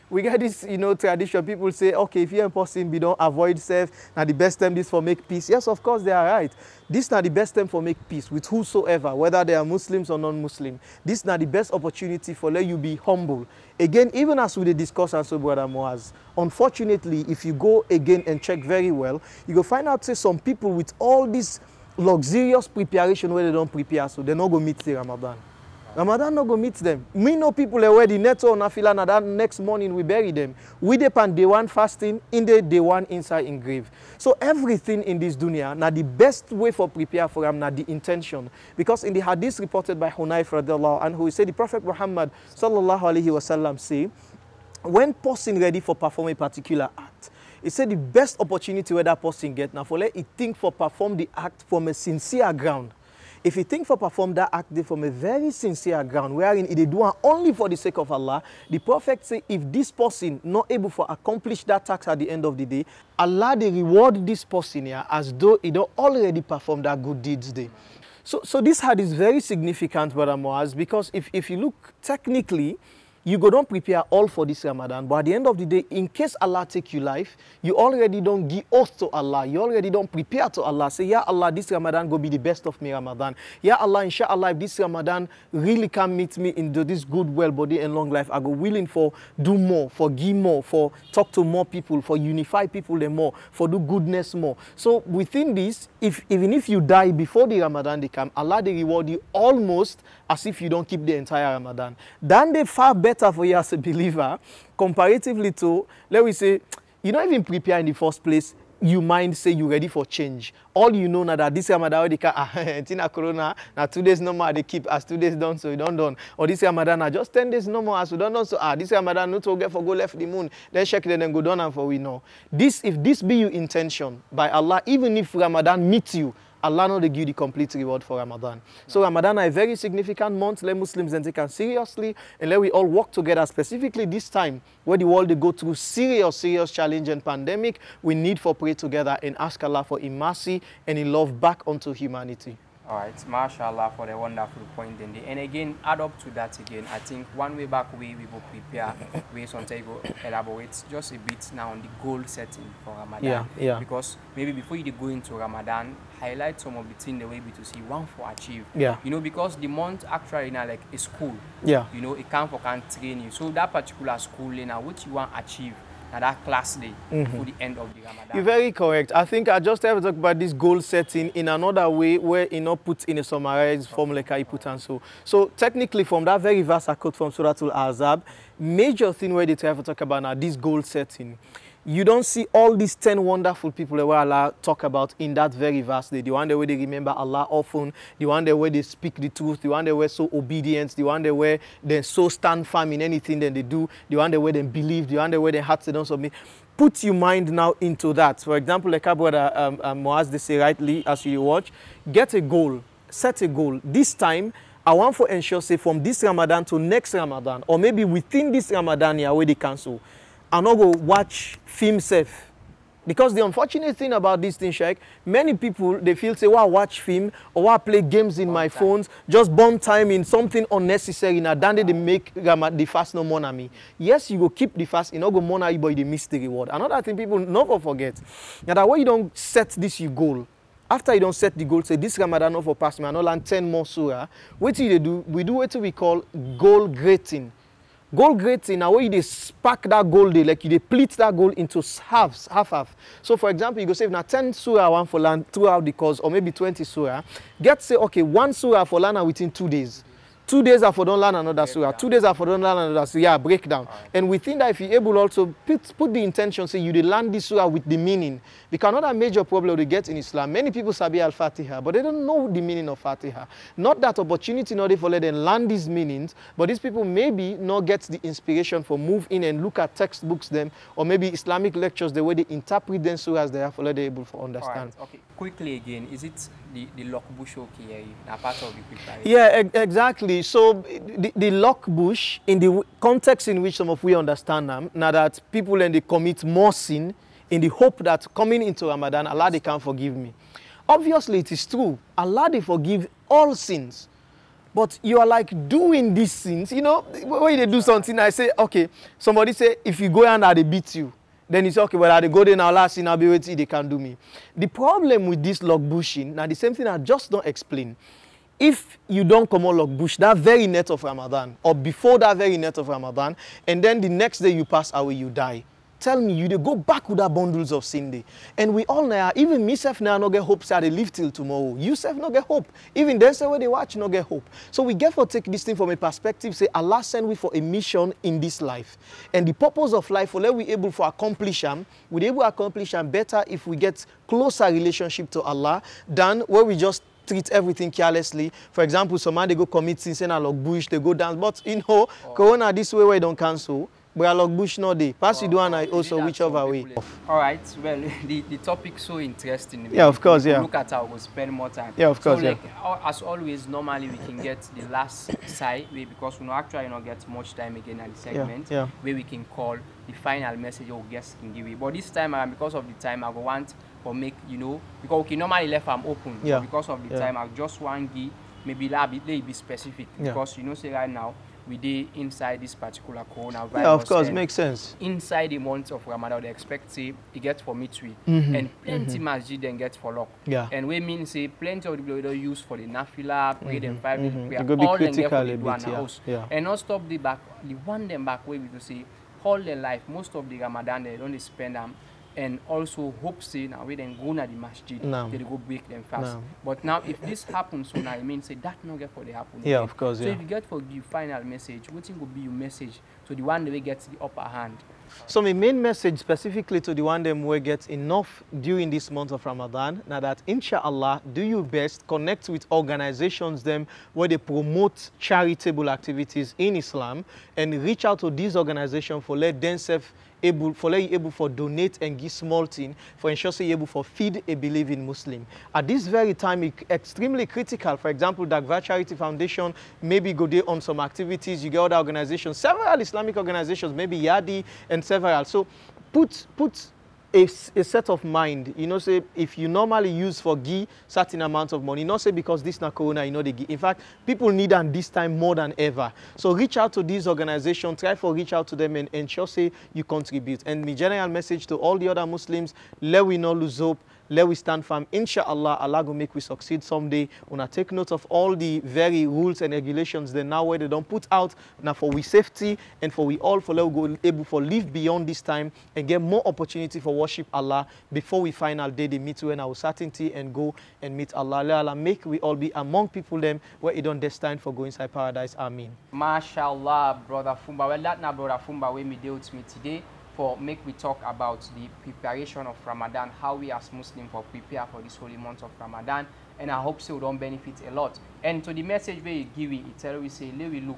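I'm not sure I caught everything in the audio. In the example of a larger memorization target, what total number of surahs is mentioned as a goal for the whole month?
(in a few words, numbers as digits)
20.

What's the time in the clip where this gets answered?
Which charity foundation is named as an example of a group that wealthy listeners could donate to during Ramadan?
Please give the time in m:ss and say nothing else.
7:08.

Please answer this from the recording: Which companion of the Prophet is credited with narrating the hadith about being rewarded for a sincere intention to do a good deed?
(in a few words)
Hunayf.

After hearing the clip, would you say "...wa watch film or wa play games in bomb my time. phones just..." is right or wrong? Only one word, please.
right.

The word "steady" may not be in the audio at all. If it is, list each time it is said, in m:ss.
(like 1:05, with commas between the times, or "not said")
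not said.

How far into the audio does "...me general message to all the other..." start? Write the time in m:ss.
7:30.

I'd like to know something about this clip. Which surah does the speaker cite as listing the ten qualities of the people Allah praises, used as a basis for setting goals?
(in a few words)
Suratul Azab.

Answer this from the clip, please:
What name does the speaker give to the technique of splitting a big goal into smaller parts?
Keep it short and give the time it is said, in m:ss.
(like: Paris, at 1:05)
Goal grading, at 3:56.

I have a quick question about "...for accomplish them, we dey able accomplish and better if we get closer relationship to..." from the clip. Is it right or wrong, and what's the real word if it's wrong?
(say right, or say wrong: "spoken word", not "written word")
right.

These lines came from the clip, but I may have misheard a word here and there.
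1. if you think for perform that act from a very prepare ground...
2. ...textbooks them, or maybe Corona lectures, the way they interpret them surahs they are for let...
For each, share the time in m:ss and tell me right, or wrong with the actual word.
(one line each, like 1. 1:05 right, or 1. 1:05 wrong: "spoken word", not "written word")
1. 0:53 wrong: "sincere", not "prepare"
2. 4:29 wrong: "Islamic", not "Corona".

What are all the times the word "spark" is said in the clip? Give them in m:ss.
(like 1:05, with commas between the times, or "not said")
3:59.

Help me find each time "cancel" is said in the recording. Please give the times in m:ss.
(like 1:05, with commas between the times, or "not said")
3:29, 5:43.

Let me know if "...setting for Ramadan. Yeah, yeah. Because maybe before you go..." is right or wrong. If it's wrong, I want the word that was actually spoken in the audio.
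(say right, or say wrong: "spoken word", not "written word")
right.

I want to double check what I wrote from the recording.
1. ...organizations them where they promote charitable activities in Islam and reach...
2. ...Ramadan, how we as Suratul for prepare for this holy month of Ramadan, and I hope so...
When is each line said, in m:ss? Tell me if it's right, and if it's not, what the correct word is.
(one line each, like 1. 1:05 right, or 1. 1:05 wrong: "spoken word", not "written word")
1. 6:52 right
2. 8:02 wrong: "Muslims", not "Suratul".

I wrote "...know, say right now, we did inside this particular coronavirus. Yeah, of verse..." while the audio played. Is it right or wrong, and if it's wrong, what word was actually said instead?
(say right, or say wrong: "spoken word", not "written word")
wrong: "course", not "verse".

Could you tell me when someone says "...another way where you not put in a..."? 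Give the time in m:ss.
2:51.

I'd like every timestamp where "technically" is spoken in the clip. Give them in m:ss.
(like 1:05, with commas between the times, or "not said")
1:12, 2:55.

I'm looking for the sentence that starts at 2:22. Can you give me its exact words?
All right, mashallah for the wonderful point.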